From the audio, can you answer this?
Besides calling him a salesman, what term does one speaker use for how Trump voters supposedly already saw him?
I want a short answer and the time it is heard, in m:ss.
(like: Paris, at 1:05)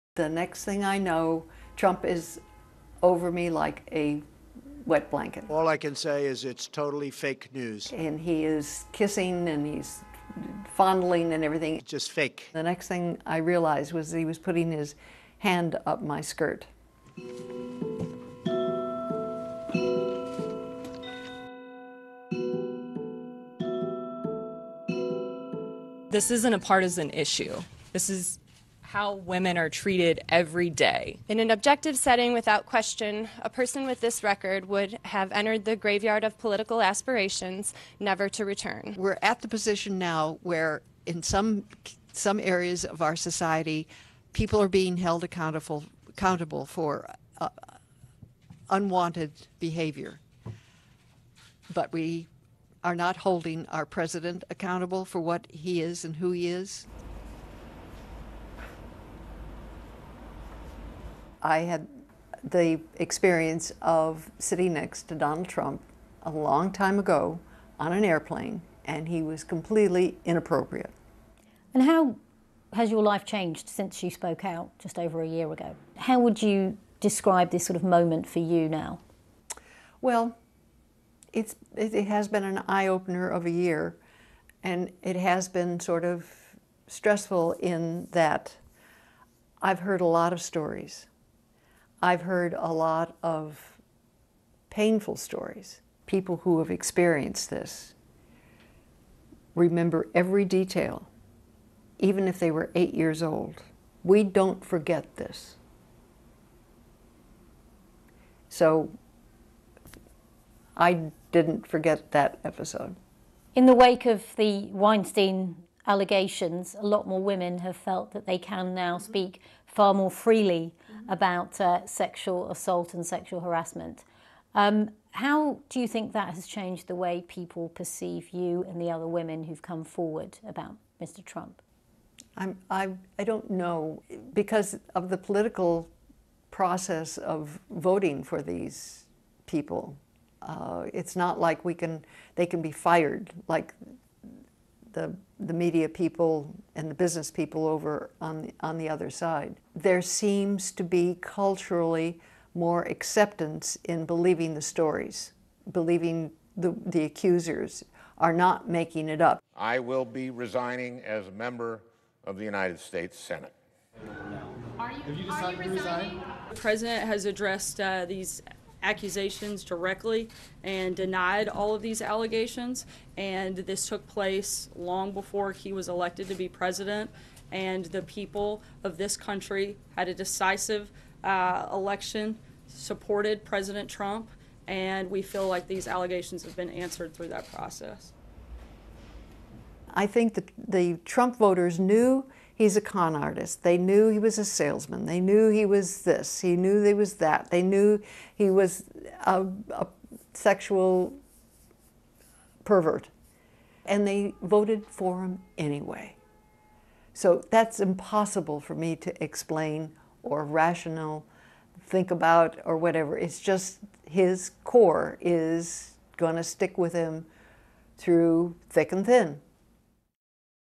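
con artist, at 3:12.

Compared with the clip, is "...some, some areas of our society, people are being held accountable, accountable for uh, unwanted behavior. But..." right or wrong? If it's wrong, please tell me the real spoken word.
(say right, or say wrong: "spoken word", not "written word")
right.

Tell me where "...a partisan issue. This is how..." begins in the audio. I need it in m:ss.
0:26.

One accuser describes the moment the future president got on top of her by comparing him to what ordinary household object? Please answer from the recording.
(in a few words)
wet blanket.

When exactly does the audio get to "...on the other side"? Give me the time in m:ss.
2:28.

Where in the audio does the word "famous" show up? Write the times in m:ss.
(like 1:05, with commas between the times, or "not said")
not said.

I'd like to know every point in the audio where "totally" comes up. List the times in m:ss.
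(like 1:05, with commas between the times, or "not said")
0:06.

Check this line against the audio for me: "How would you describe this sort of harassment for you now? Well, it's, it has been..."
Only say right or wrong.
wrong.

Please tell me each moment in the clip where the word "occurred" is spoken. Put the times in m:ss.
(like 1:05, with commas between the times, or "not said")
not said.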